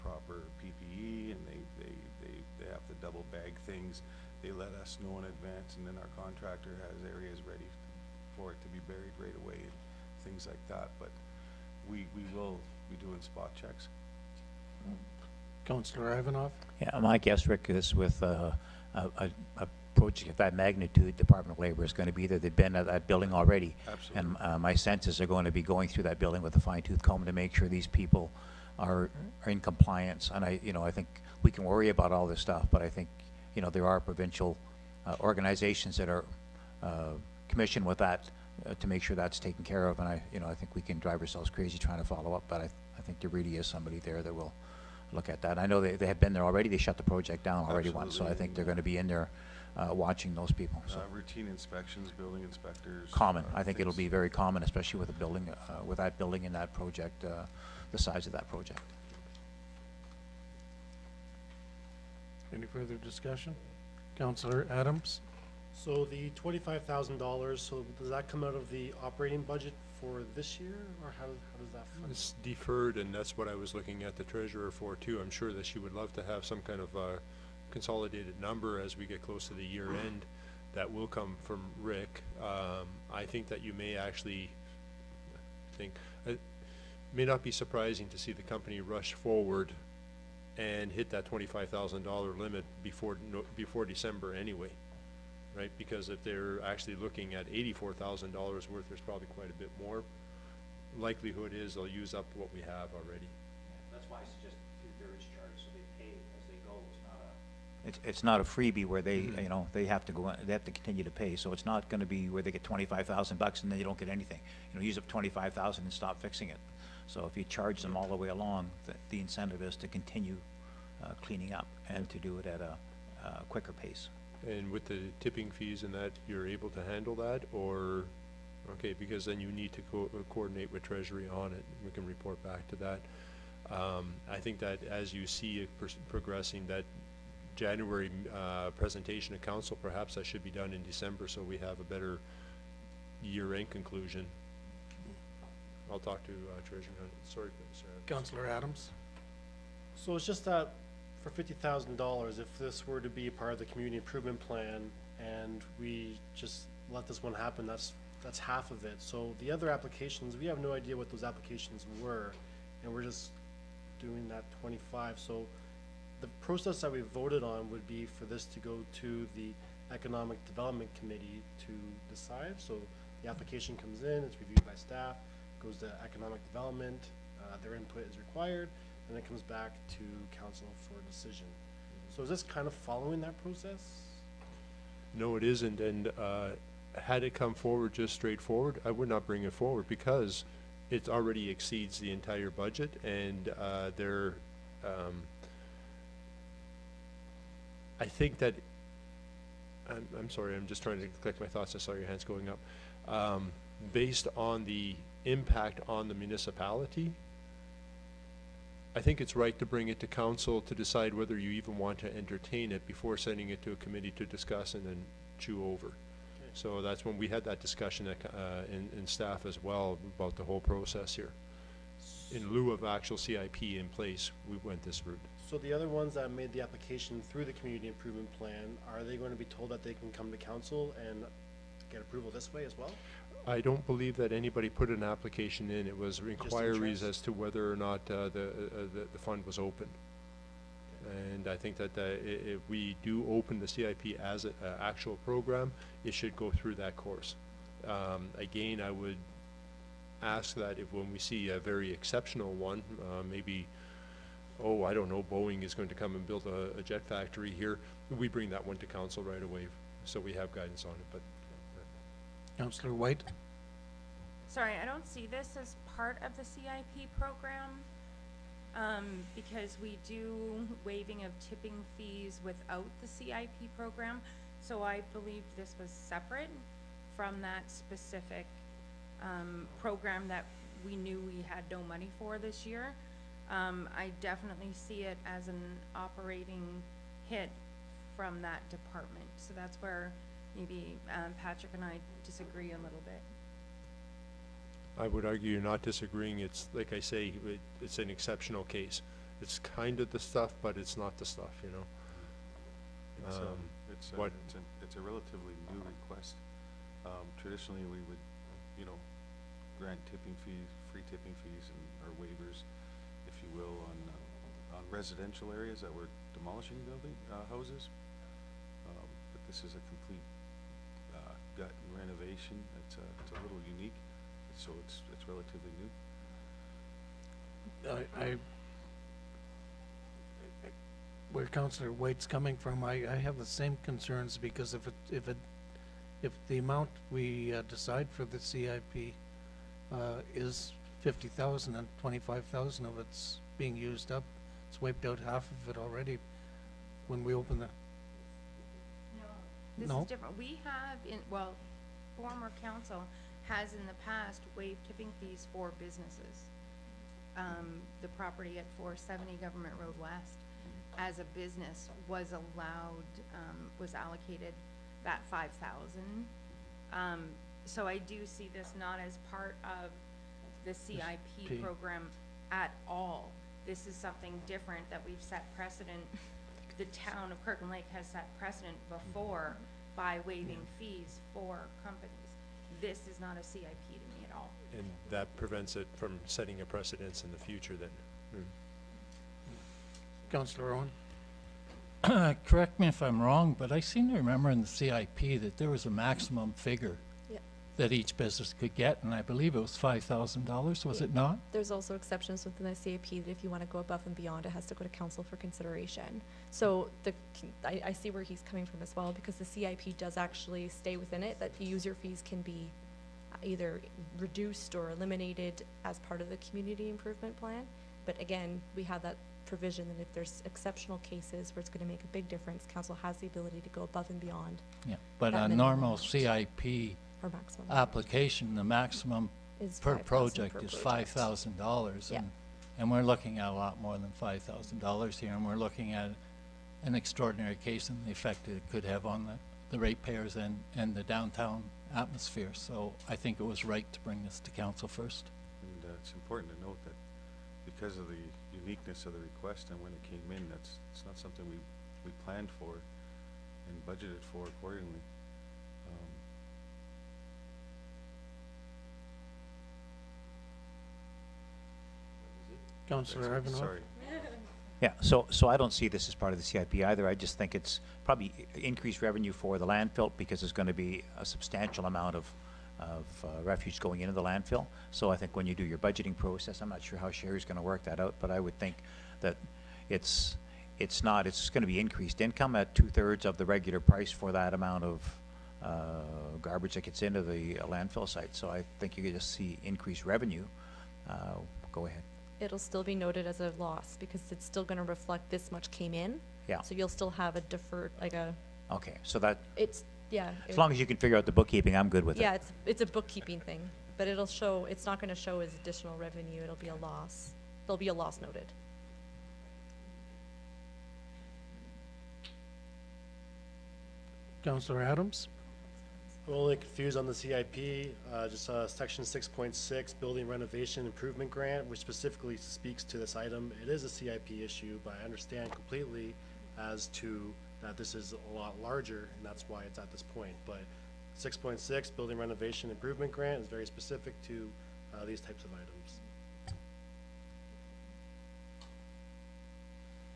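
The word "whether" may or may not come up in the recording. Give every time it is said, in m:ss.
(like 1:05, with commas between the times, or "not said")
3:31, 3:57.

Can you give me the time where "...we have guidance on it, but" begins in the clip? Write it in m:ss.
4:20.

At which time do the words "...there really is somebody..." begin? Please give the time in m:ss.
0:43.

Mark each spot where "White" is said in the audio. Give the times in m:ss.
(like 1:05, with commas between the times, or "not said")
4:22, 5:31.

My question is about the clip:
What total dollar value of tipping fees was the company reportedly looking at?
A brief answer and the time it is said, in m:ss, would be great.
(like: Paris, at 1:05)
$84,000, at 1:37.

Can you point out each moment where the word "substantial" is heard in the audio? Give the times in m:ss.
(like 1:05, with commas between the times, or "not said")
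7:51.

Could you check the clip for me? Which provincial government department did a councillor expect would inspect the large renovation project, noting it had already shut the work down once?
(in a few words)
Department of Labor.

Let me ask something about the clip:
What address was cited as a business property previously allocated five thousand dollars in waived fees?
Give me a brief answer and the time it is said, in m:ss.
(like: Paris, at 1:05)
470 Government Road West, at 5:58.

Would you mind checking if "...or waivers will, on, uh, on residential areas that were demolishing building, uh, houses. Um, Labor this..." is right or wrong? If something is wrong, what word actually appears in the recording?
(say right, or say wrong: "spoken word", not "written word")
wrong: "But", not "Labor".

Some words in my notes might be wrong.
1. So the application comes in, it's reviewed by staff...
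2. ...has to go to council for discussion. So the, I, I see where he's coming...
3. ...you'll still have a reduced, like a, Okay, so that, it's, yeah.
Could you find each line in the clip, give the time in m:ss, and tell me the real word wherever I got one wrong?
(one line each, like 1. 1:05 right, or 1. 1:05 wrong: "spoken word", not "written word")
1. 2:52 right
2. 6:44 wrong: "consideration", not "discussion"
3. 8:16 wrong: "deferred", not "reduced".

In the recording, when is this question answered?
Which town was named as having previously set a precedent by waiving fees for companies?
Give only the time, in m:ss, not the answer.
6:17.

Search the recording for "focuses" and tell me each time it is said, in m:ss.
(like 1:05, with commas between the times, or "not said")
not said.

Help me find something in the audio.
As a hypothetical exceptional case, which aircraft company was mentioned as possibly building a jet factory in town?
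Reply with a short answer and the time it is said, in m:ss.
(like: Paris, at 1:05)
Boeing, at 4:15.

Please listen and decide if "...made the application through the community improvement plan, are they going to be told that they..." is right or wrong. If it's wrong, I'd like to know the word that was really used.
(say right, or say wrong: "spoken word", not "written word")
right.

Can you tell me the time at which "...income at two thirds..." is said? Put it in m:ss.
8:02.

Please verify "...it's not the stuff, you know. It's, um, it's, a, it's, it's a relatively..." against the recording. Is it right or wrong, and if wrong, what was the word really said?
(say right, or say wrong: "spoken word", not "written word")
right.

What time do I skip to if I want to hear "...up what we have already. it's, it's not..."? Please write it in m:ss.
1:42.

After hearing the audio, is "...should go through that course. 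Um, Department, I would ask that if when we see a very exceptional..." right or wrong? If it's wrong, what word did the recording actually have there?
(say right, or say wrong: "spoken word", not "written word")
wrong: "Again", not "Department".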